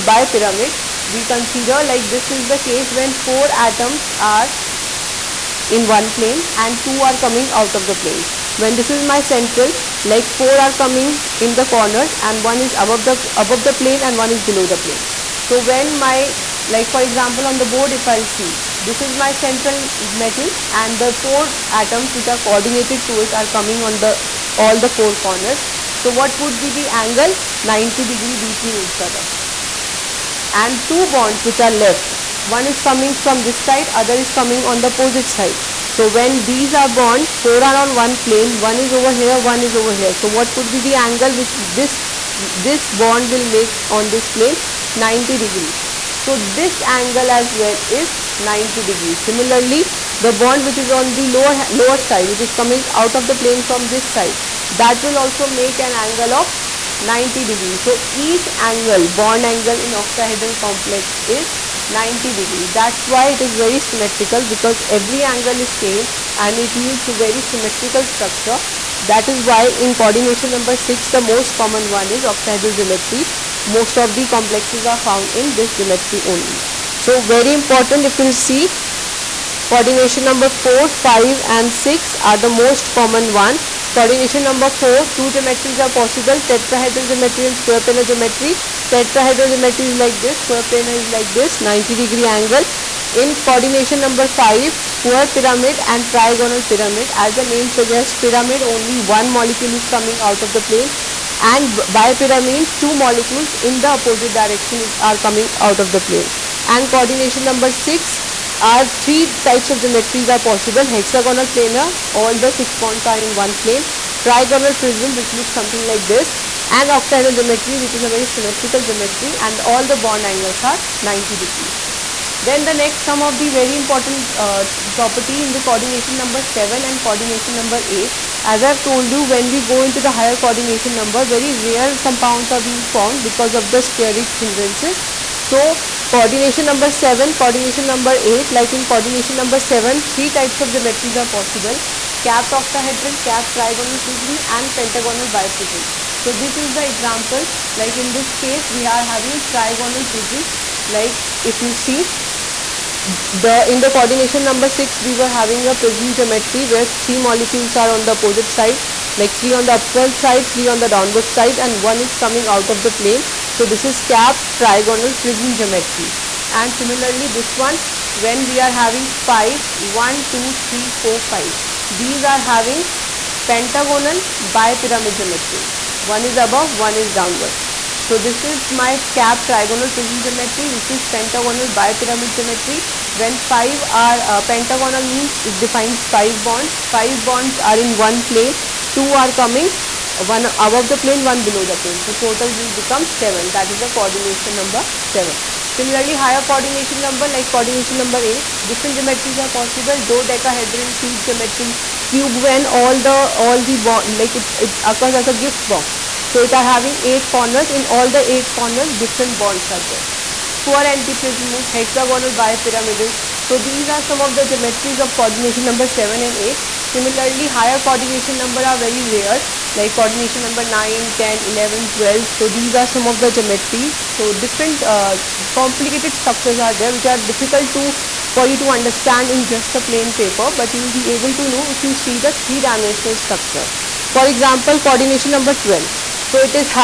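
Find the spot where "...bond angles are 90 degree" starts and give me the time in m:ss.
1:59.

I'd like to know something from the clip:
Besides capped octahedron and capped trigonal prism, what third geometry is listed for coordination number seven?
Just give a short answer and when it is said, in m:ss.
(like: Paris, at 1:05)
Pentagonal biprism, at 2:24.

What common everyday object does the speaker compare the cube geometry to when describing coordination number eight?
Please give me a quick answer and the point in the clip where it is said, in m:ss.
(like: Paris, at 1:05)
Gift box, at 3:25.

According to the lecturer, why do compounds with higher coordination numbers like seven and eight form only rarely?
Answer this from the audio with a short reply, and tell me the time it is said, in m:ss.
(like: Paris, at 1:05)
Steric hindrances, at 2:13.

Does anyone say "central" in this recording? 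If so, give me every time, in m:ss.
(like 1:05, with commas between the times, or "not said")
0:09, 0:19.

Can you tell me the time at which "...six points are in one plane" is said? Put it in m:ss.
1:52.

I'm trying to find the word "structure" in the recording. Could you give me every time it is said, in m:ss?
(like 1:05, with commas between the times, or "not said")
1:08, 3:46, 3:53.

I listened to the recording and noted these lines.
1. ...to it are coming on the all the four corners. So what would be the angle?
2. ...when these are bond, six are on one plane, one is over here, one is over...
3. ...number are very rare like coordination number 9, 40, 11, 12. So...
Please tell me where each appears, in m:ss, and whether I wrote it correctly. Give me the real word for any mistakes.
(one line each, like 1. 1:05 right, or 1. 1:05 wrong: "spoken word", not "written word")
1. 0:23 right
2. 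0:36 wrong: "four", not "six"
3. 3:38 wrong: "10", not "40".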